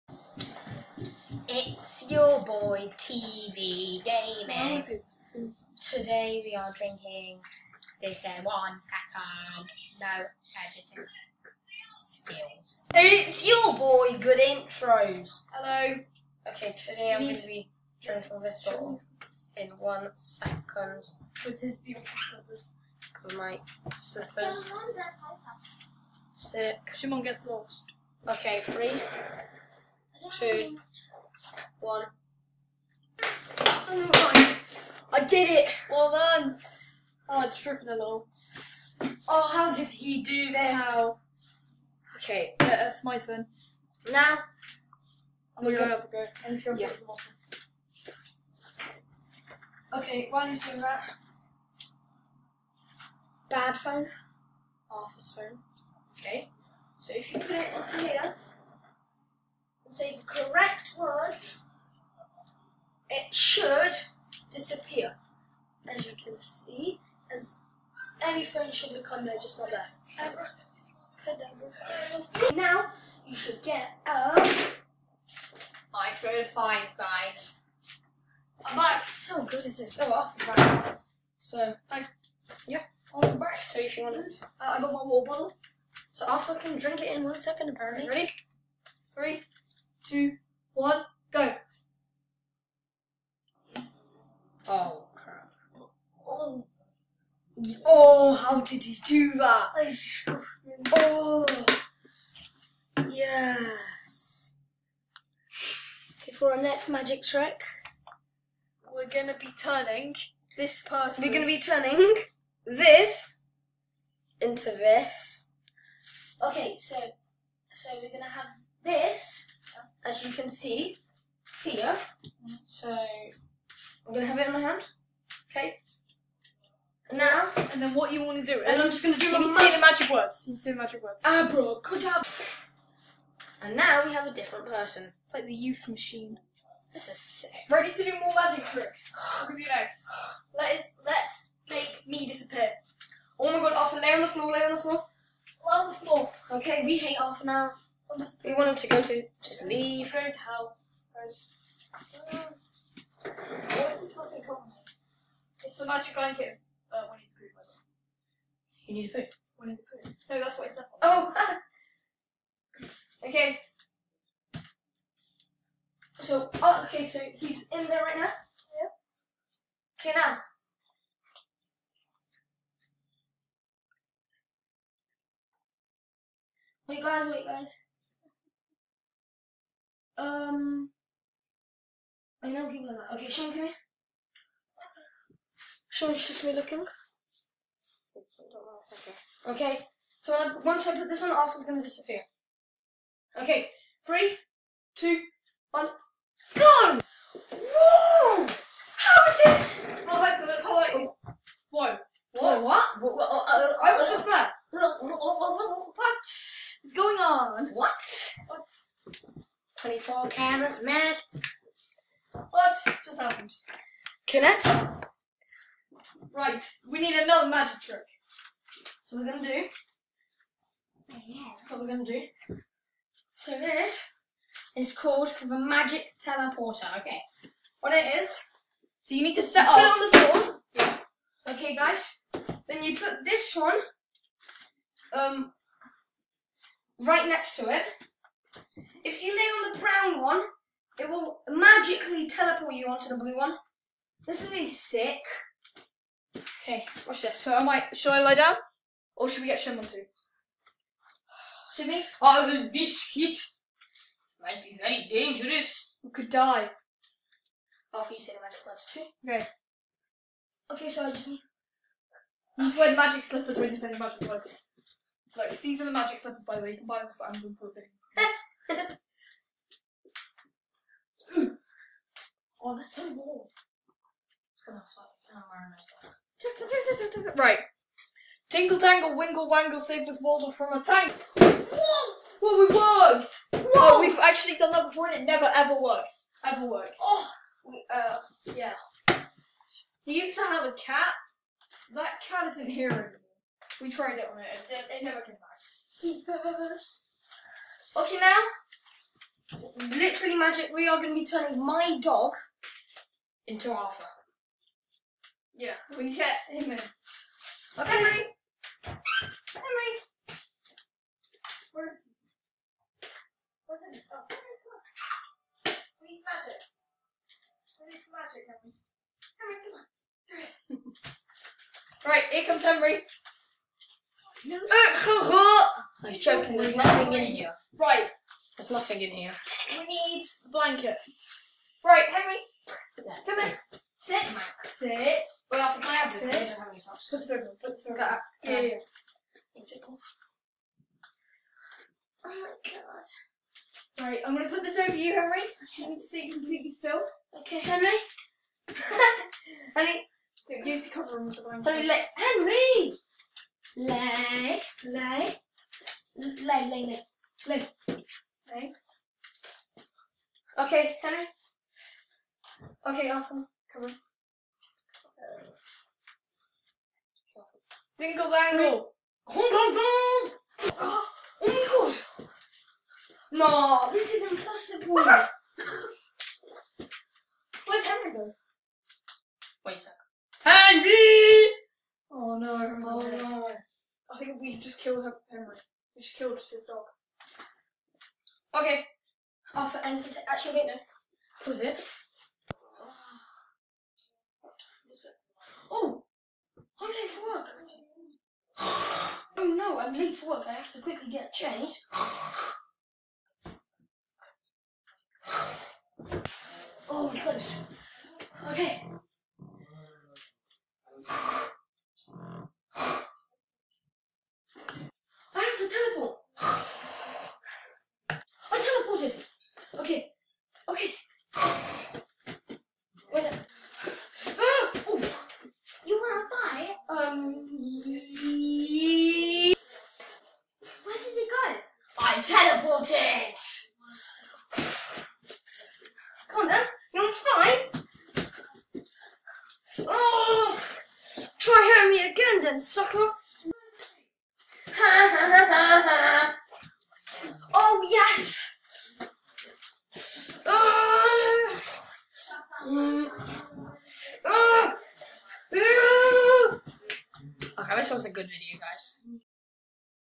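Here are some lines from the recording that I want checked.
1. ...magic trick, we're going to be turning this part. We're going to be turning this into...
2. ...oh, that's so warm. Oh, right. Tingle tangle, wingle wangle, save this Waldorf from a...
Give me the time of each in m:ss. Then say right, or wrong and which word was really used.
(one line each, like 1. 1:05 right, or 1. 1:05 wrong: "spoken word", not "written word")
1. 1:46 right
2. 4:32 right.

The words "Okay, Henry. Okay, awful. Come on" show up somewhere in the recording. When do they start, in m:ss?
6:00.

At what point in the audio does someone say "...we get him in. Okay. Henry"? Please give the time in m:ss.
5:05.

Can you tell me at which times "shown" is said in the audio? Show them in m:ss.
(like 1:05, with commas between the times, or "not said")
not said.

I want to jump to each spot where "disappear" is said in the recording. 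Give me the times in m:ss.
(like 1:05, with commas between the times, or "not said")
1:04, 2:22, 3:11.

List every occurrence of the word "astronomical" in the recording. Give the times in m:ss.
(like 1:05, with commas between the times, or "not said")
not said.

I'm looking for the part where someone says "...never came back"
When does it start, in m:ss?
4:55.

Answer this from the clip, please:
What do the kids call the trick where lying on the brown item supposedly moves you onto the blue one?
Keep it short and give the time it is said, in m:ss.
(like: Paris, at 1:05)
the magic teleporter, at 3:45.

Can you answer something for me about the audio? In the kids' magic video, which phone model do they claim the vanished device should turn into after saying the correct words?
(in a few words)
iPhone 5.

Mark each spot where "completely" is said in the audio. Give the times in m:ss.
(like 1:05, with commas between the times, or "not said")
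5:46.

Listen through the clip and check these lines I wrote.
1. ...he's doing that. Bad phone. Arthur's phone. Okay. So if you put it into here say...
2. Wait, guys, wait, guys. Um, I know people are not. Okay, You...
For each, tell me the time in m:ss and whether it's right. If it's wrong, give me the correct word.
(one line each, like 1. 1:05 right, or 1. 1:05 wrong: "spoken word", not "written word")
1. 0:50 right
2. 2:56 wrong: "Sean", not "You".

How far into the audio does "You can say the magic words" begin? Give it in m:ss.
2:10.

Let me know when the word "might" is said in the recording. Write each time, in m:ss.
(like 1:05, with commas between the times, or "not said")
4:07, 4:14.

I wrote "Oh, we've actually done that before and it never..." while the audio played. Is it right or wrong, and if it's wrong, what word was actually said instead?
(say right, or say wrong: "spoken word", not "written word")
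right.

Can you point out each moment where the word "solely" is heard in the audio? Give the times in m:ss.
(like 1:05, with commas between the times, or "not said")
not said.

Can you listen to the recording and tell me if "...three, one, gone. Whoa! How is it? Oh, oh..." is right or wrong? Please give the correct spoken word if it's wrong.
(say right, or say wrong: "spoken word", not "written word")
wrong: "two", not "three".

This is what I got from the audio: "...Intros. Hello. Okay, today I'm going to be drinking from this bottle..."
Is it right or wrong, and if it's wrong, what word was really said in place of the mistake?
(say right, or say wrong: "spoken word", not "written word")
right.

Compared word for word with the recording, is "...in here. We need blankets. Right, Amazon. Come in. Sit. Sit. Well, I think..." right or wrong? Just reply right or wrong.
wrong.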